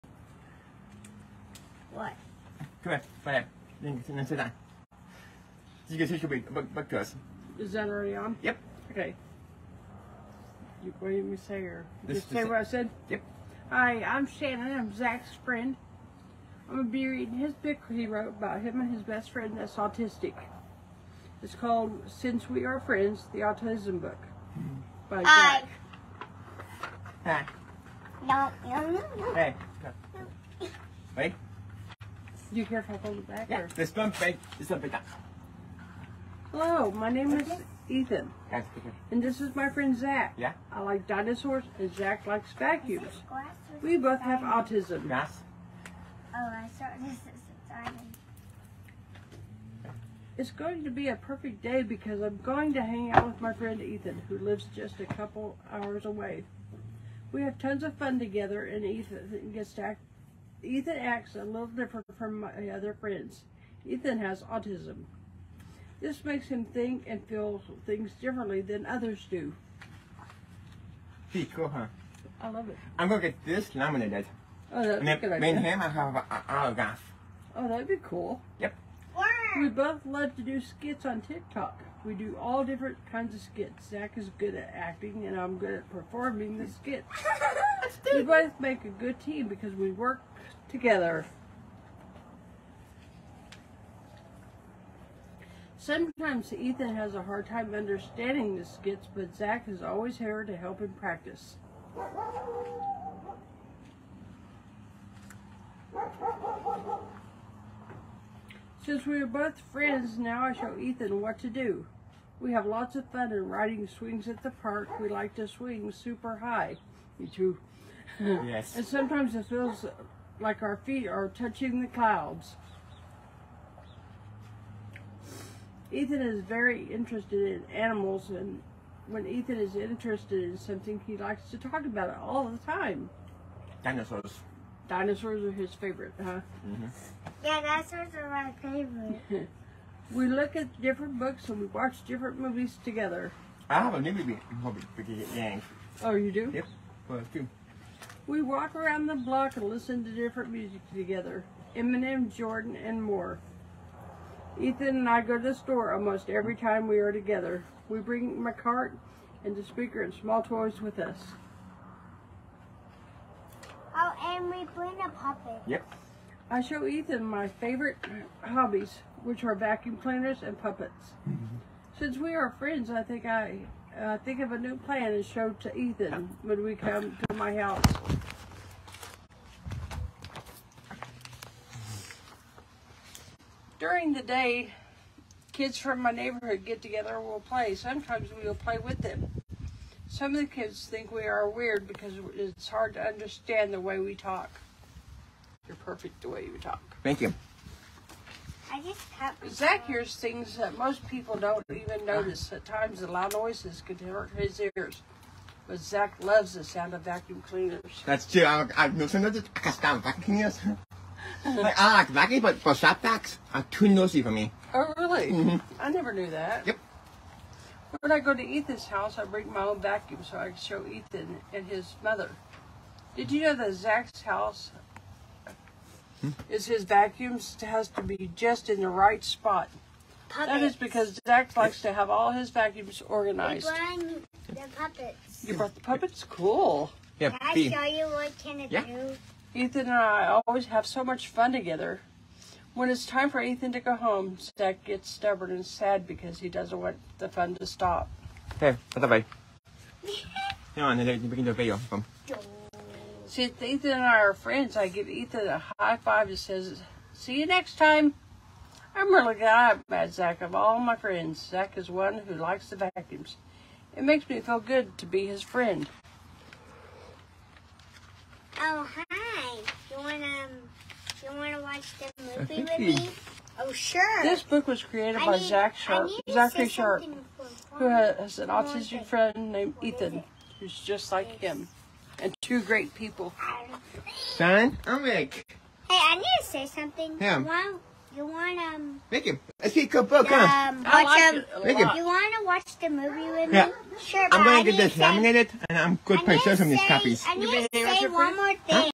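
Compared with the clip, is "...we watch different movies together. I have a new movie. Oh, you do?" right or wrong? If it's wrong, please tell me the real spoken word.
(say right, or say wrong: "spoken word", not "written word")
right.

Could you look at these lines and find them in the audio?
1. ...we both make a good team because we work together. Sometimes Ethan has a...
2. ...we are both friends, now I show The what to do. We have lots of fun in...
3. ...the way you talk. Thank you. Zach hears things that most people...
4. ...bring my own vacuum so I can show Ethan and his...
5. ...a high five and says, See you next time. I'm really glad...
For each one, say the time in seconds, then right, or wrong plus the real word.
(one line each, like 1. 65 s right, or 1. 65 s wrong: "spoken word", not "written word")
1. 88 s right
2. 109 s wrong: "Ethan", not "The"
3. 196 s right
4. 219 s right
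5. 255 s right.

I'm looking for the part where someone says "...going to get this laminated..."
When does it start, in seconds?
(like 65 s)
294 s.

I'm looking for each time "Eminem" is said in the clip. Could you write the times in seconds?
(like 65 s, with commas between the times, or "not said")
151 s.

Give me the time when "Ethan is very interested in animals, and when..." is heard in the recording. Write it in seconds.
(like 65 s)
125 s.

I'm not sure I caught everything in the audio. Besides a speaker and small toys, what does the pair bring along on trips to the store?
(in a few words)
cart.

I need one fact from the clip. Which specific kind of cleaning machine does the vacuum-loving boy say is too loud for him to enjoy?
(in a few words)
shop vacs.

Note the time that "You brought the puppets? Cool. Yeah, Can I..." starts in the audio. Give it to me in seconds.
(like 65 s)
235 s.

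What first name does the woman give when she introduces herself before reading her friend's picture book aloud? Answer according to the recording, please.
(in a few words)
Shannon.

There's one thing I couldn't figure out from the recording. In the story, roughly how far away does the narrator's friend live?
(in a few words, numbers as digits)
a couple hours.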